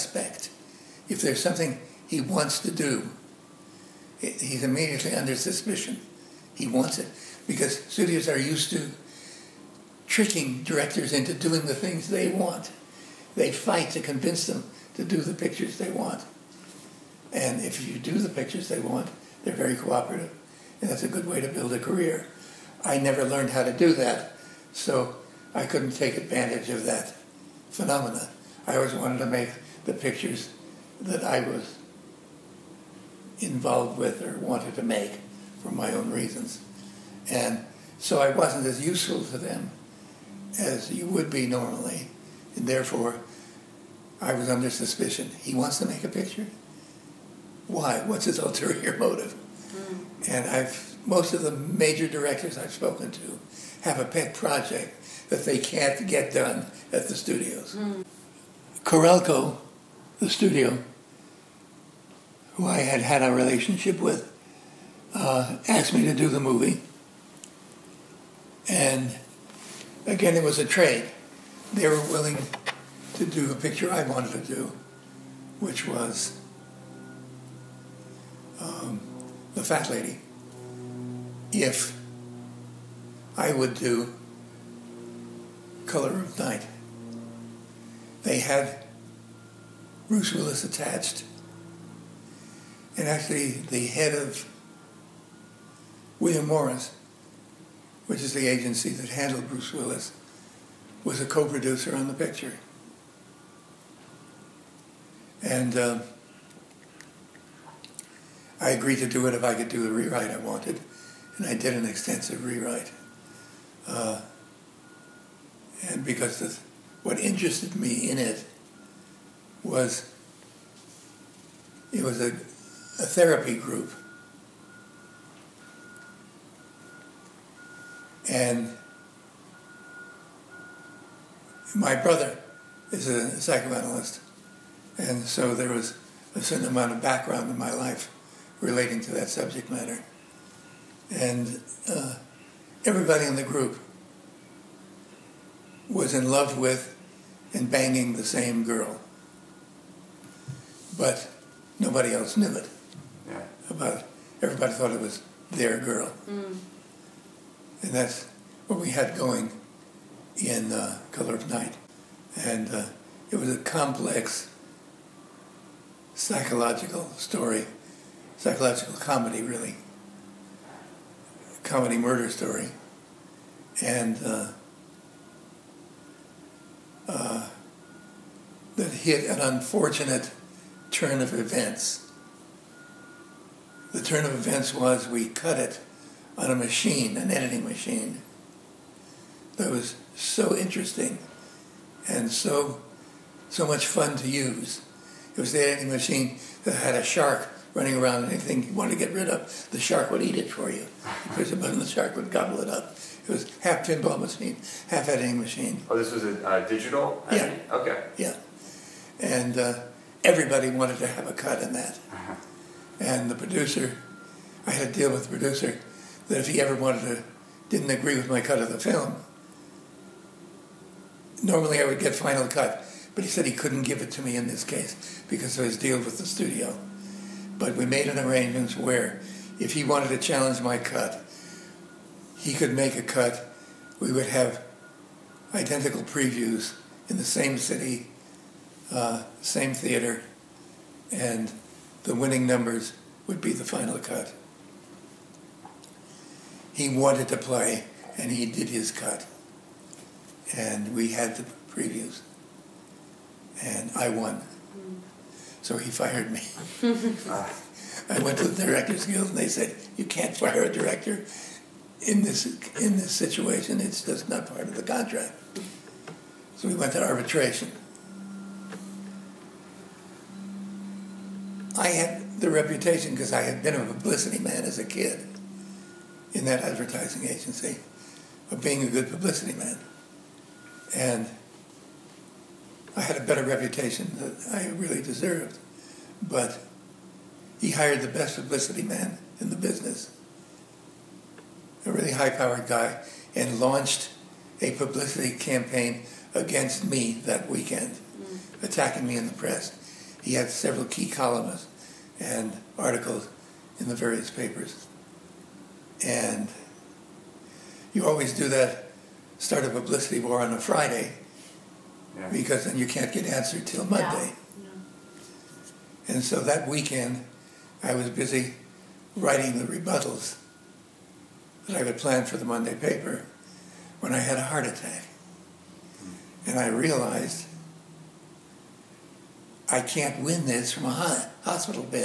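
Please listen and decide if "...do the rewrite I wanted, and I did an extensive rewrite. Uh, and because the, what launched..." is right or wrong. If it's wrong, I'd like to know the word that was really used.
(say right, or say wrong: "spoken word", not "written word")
wrong: "interested", not "launched".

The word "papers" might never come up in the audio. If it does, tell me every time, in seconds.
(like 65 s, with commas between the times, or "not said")
304 s, 322 s.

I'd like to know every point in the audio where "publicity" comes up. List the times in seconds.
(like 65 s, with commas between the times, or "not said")
273 s, 279 s, 288 s, 294 s, 309 s.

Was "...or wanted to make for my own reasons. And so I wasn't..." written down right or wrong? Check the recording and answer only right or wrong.
right.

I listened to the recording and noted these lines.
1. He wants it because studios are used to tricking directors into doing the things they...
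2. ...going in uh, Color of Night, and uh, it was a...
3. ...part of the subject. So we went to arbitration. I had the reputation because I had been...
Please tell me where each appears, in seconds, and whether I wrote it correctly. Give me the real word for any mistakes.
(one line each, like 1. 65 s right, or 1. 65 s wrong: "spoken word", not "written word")
1. 6 s right
2. 159 s right
3. 264 s wrong: "contract", not "subject".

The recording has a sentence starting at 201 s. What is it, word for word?
Because the button, the shark would gobble it up.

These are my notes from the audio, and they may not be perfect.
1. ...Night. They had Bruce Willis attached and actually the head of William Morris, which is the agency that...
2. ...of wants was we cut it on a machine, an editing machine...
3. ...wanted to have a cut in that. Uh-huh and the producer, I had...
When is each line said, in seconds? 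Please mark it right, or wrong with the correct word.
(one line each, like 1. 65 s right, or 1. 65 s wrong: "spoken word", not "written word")
1. 86 s right
2. 184 s wrong: "events", not "wants"
3. 210 s right.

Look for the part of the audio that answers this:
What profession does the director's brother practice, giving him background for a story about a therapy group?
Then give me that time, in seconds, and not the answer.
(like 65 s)
133 s.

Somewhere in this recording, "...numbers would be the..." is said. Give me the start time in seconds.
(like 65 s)
242 s.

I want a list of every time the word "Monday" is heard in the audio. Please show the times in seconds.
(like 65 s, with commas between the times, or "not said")
313 s, 322 s.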